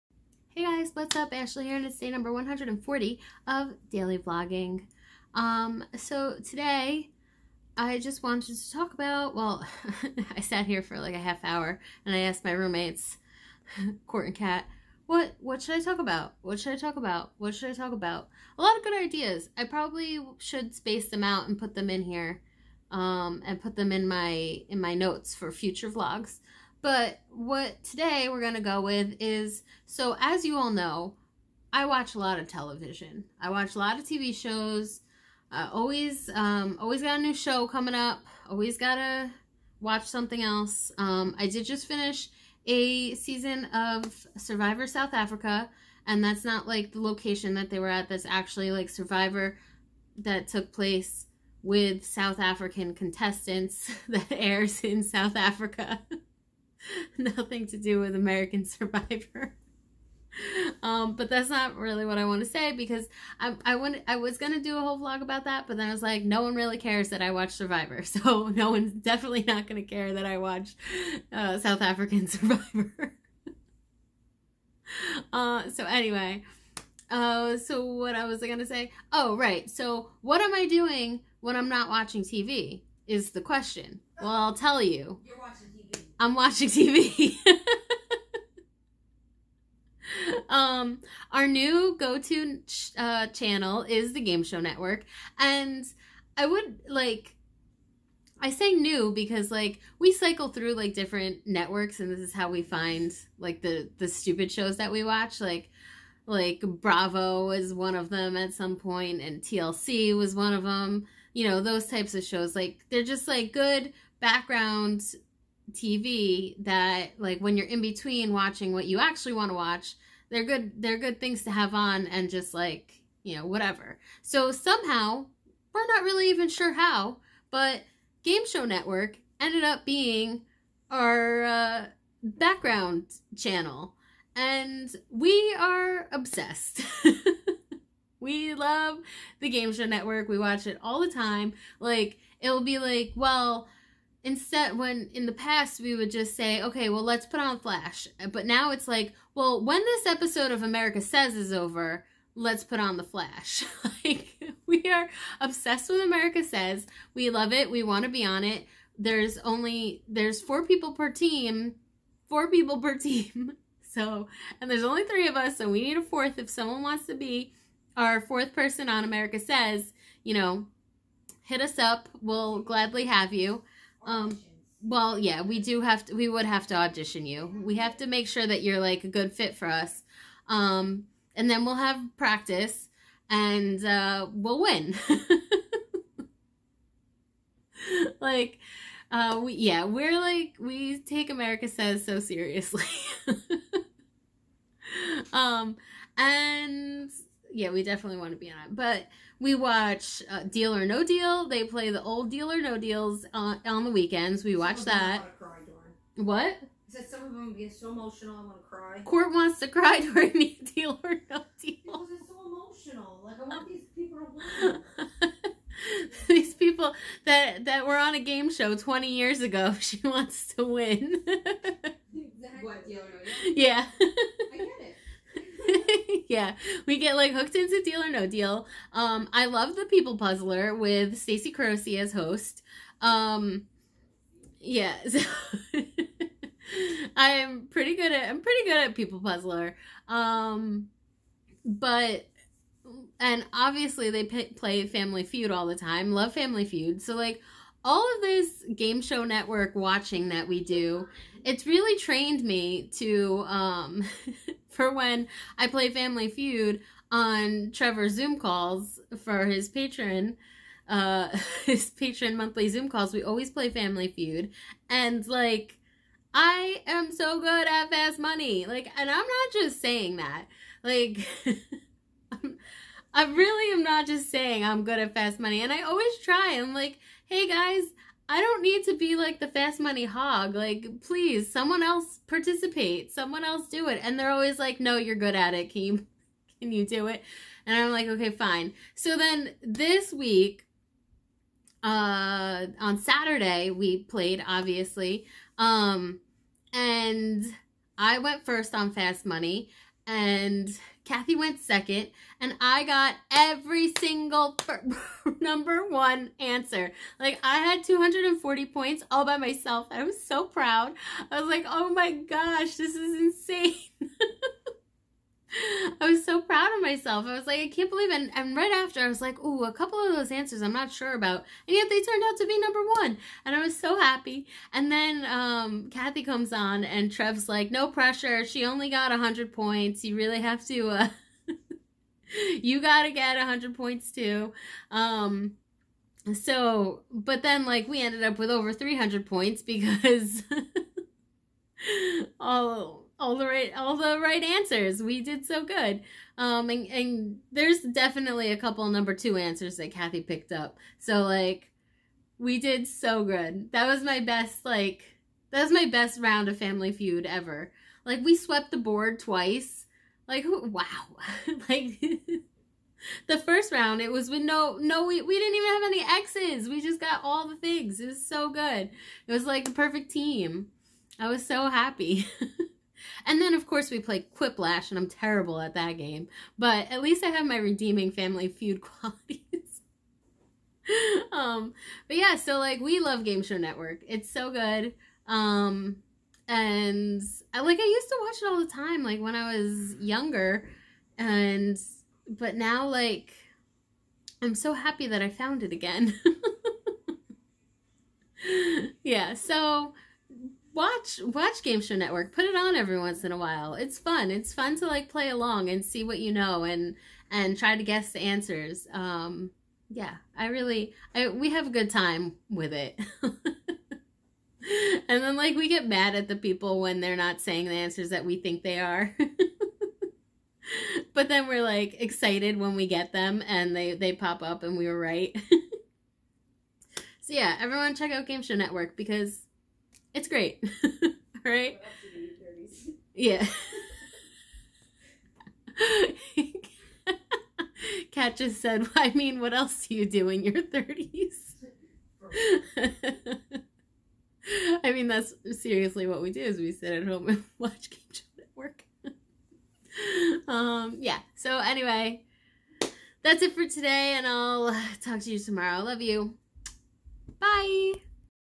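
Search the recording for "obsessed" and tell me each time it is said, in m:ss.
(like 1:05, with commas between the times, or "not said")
2:16, 2:35.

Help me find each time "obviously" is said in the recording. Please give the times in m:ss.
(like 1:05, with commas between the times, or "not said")
4:03, 4:54.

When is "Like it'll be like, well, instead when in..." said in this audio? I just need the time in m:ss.
2:21.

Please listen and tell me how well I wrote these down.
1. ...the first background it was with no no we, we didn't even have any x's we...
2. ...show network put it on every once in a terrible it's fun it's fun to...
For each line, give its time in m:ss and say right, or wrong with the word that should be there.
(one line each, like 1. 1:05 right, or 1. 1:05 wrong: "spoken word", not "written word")
1. 6:03 wrong: "round", not "background"
2. 6:41 wrong: "while", not "terrible".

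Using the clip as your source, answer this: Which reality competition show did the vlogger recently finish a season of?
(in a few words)
Survivor South Africa.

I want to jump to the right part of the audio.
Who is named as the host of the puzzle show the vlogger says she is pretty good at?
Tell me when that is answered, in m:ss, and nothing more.
3:51.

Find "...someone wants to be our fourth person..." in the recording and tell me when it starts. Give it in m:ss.
2:46.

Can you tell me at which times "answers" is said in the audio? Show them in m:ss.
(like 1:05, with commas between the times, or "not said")
5:06, 5:20, 5:44, 5:49, 6:48, 6:57.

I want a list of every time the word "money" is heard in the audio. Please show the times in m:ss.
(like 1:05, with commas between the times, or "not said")
4:28, 4:35, 4:39, 4:59.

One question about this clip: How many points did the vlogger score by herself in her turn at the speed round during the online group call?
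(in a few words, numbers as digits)
240.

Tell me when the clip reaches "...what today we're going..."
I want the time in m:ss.
0:27.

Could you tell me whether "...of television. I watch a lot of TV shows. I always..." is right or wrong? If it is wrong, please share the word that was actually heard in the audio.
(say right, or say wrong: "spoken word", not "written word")
right.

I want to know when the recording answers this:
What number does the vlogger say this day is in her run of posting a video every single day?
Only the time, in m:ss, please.
0:02.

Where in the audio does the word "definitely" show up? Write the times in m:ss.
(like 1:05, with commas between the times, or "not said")
1:08, 3:17, 5:47.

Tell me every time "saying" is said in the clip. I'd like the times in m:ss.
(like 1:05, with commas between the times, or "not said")
4:29, 4:34, 6:57.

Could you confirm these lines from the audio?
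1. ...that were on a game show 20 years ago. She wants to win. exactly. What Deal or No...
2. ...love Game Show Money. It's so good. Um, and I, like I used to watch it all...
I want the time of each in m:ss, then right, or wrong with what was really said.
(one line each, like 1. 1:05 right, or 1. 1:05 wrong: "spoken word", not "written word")
1. 3:37 right
2. 6:22 wrong: "Network", not "Money".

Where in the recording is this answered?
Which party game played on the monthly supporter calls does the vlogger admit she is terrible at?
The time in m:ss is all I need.
6:14.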